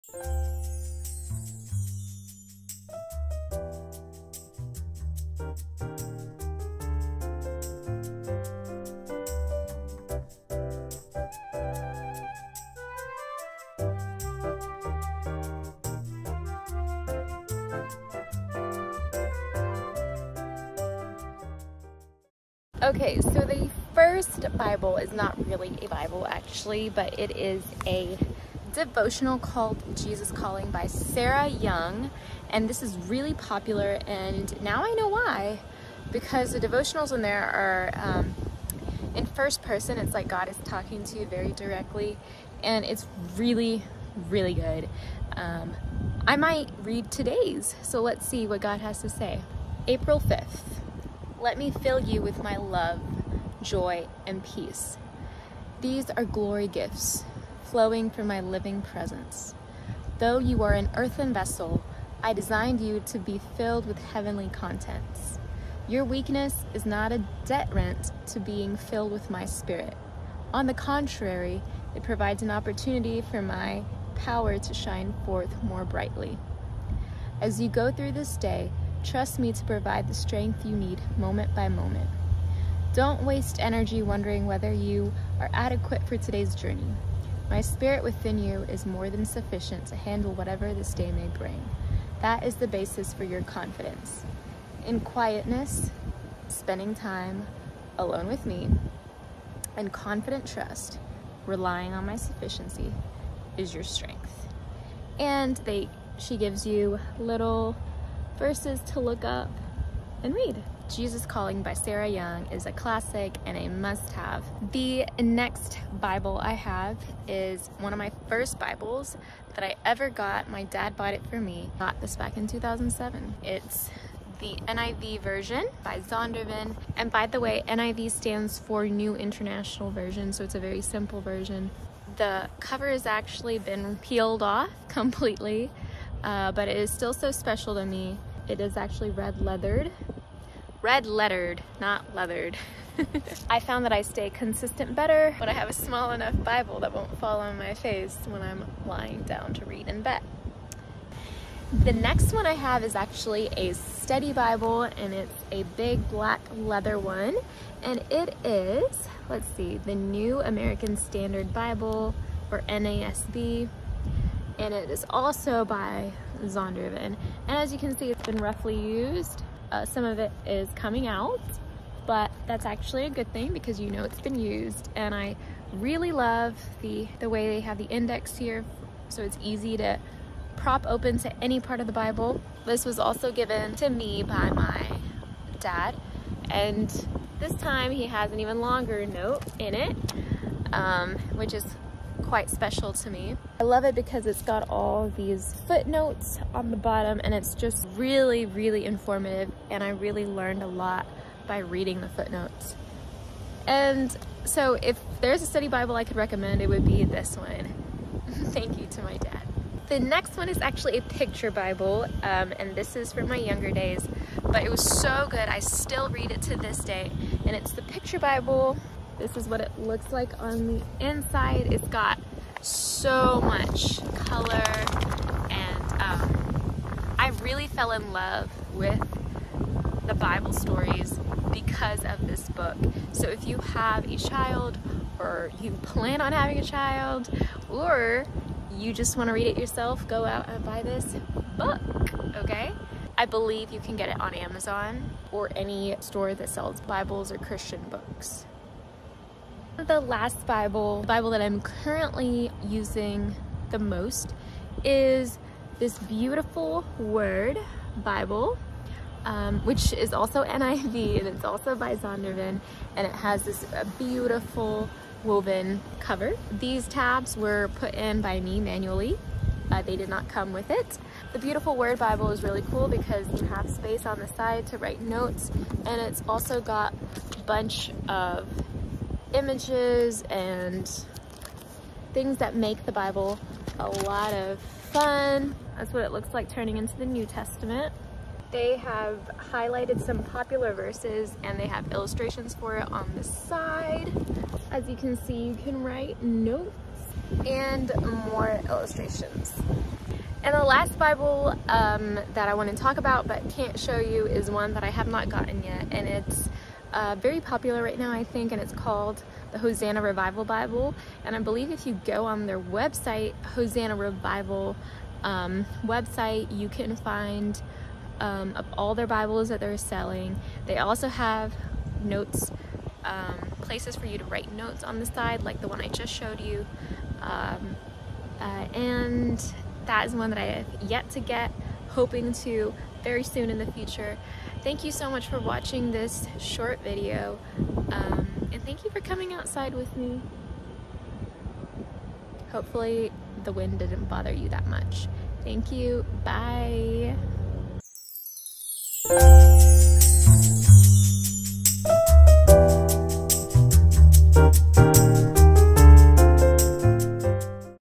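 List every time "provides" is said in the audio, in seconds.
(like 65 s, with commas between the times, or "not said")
72 s, 79 s.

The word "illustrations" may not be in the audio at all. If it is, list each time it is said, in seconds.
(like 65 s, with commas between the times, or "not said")
291 s, 298 s.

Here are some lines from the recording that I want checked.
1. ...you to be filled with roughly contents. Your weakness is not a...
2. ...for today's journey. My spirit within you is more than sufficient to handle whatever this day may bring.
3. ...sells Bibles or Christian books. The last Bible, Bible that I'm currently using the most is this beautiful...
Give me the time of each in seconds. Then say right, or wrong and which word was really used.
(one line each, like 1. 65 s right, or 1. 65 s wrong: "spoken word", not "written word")
1. 62 s wrong: "heavenly", not "roughly"
2. 86 s right
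3. 246 s right.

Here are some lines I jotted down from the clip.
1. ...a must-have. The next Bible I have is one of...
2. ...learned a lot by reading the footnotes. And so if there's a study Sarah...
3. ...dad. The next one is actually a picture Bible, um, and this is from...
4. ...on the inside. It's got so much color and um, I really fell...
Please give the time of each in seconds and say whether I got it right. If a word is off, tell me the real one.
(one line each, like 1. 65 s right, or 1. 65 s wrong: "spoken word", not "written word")
1. 113 s right
2. 200 s wrong: "Bible", not "Sarah"
3. 209 s right
4. 220 s right.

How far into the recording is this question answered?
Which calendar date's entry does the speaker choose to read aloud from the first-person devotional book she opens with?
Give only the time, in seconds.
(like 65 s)
49 s.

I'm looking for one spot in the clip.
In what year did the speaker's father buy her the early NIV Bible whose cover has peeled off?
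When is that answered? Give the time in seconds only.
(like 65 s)
122 s.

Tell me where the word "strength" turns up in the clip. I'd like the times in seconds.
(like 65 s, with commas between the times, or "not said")
80 s, 103 s.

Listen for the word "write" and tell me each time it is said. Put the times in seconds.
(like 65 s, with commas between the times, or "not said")
274 s, 295 s, 324 s.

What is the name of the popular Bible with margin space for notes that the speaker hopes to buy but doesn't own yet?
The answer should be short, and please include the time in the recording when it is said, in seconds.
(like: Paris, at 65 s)
Hosanna Revival Bible, at 309 s.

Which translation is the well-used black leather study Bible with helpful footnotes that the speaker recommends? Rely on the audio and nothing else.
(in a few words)
New American Standard Bible.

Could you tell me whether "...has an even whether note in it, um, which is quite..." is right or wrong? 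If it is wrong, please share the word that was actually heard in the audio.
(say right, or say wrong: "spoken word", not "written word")
wrong: "longer", not "whether".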